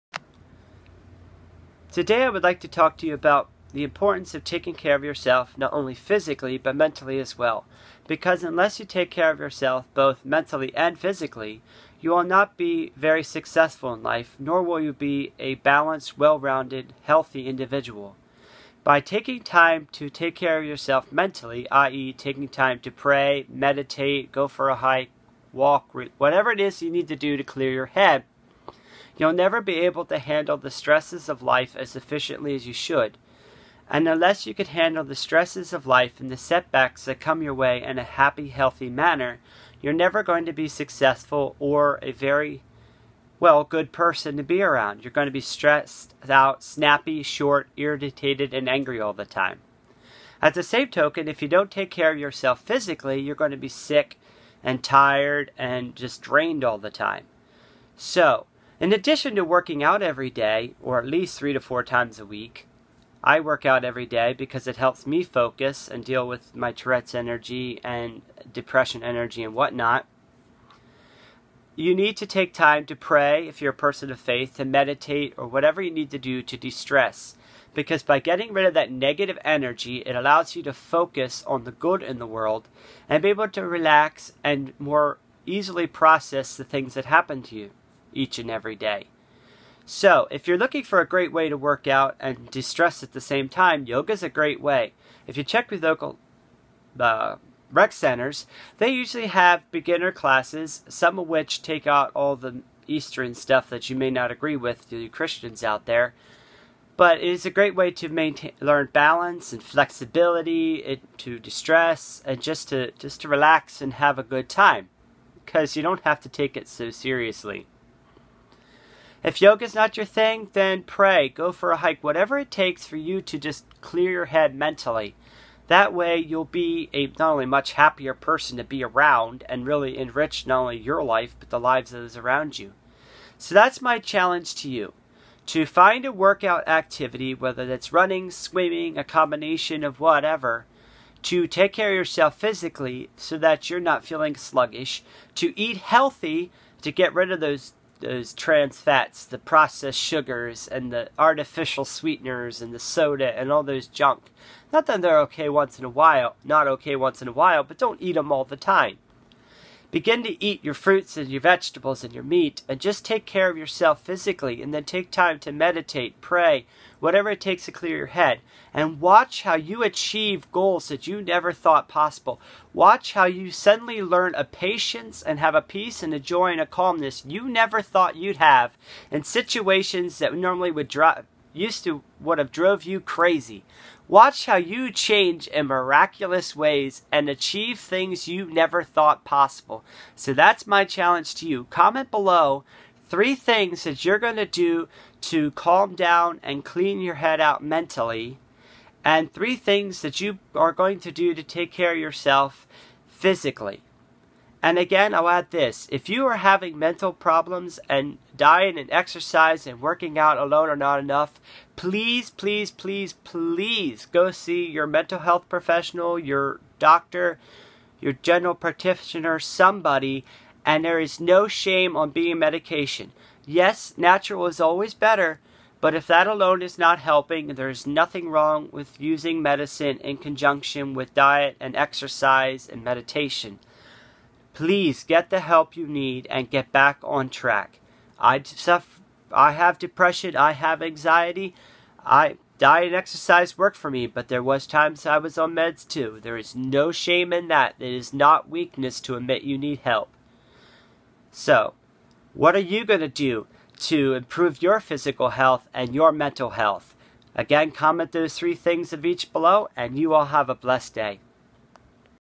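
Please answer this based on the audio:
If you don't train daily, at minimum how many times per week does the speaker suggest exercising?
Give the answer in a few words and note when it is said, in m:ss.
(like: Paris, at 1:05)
3 to 4, at 1:01.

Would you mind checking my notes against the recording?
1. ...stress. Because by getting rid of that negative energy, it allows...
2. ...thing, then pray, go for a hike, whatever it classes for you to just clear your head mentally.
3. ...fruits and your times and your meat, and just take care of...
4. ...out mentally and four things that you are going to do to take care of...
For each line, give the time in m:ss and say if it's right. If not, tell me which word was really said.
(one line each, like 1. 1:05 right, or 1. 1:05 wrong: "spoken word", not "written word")
1. 1:16 right
2. 2:00 wrong: "takes", not "classes"
3. 2:40 wrong: "vegetables", not "times"
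4. 3:17 wrong: "three", not "four".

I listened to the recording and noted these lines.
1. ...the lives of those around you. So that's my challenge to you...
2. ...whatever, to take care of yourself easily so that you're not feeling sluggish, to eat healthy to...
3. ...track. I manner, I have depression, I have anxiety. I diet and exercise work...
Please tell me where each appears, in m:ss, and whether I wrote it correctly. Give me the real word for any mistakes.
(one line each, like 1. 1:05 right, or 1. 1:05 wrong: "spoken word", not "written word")
1. 2:11 right
2. 2:19 wrong: "physically", not "easily"
3. 3:57 wrong: "suffer", not "manner".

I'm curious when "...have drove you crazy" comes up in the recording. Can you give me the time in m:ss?
3:02.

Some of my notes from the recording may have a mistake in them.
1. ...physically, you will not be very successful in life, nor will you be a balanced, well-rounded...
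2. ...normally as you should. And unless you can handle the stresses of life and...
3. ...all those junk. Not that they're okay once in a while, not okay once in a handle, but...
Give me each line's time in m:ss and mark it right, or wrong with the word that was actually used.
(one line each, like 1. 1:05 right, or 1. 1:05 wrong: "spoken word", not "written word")
1. 0:10 right
2. 0:31 wrong: "efficiently", not "normally"
3. 2:33 wrong: "while", not "handle".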